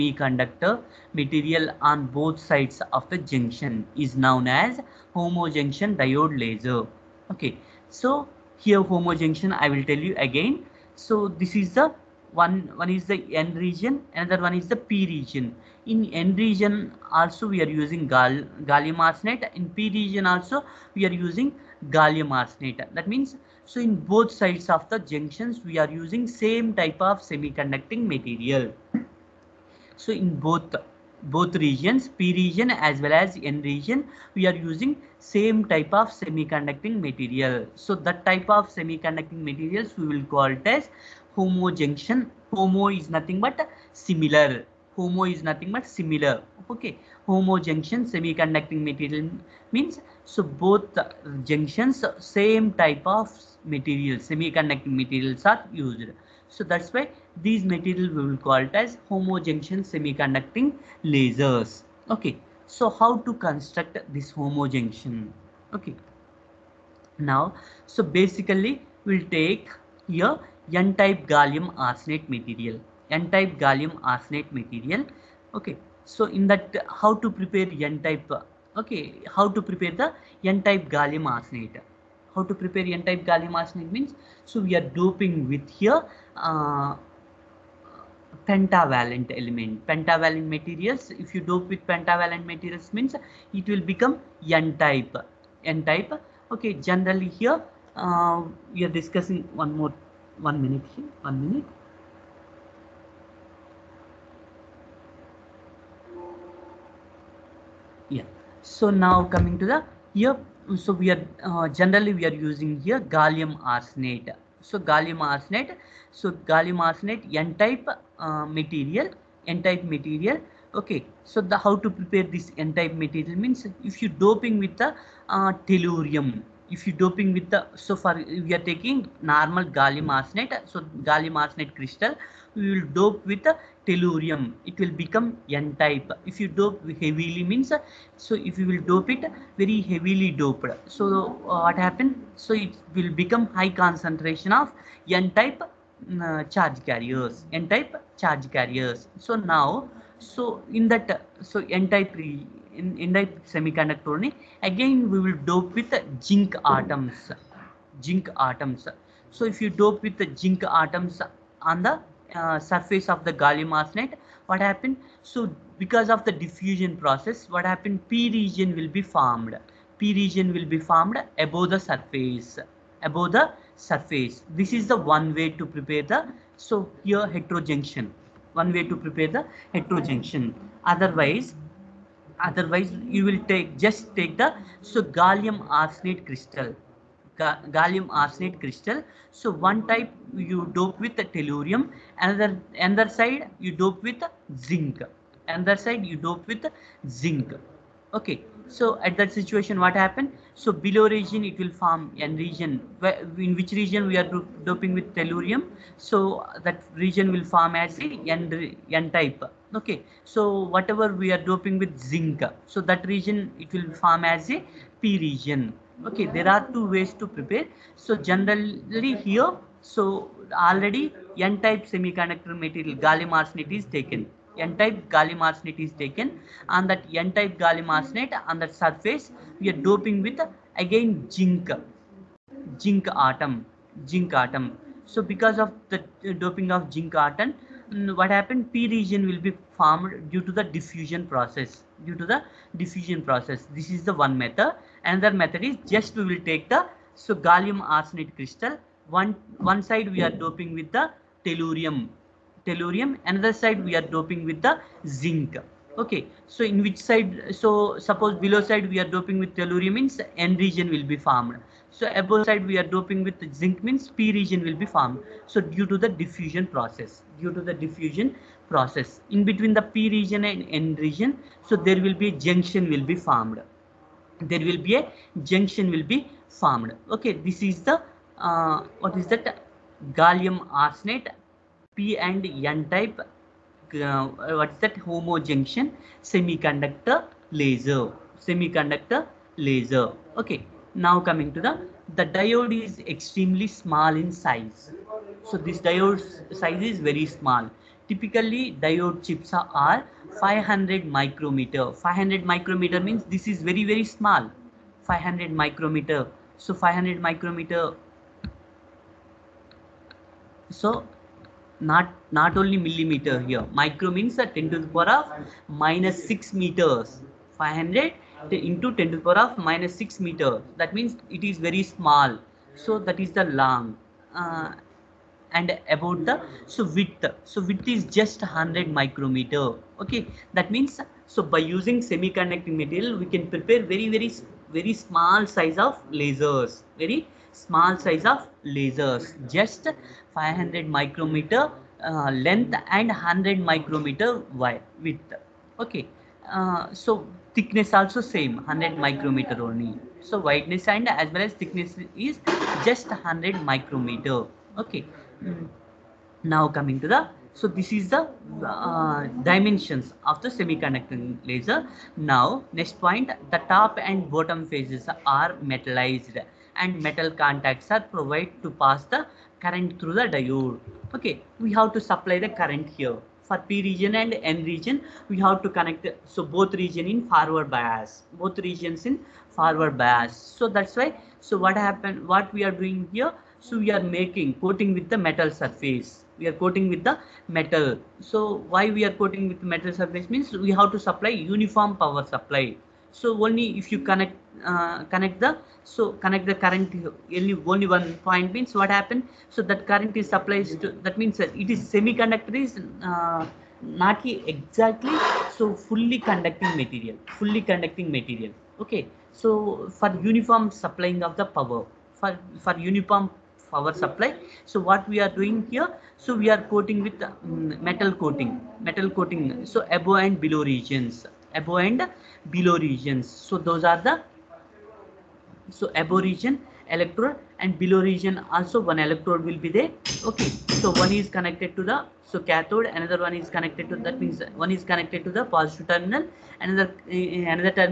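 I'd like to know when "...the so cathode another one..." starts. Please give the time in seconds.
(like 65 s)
431 s.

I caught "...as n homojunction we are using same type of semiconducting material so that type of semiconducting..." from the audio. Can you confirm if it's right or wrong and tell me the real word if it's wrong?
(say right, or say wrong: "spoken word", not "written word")
wrong: "region", not "homojunction".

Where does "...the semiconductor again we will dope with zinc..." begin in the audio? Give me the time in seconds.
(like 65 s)
153 s.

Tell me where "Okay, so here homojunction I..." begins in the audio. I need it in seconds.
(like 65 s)
7 s.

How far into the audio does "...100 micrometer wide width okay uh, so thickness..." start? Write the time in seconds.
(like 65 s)
343 s.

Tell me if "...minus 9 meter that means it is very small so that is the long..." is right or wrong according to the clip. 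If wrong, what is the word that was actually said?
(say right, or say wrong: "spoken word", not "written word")
wrong: "6", not "9".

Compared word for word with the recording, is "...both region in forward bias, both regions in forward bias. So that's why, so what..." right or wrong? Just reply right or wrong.
right.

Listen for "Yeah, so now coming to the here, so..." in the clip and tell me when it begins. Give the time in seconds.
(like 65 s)
108 s.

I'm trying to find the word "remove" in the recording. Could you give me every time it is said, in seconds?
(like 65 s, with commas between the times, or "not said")
not said.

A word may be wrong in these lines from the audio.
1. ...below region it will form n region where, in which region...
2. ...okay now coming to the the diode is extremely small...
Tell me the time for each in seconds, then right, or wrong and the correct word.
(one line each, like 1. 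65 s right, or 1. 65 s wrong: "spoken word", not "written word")
1. 200 s right
2. 290 s right.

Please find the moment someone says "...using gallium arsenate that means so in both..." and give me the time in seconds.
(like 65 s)
21 s.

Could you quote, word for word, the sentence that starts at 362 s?
Now next point, the top and bottom phases are metallized and metal contacts are provided to pass the current through the diode.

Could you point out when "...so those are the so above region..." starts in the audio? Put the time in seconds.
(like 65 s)
423 s.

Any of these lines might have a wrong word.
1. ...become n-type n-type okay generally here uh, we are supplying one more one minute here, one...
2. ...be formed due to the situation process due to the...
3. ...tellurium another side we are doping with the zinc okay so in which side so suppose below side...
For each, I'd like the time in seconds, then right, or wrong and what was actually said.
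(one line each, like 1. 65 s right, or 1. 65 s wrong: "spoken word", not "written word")
1. 93 s wrong: "discussing", not "supplying"
2. 239 s wrong: "diffusion", not "situation"
3. 252 s right.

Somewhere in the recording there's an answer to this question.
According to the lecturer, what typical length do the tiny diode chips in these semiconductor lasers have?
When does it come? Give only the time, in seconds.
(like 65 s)
298 s.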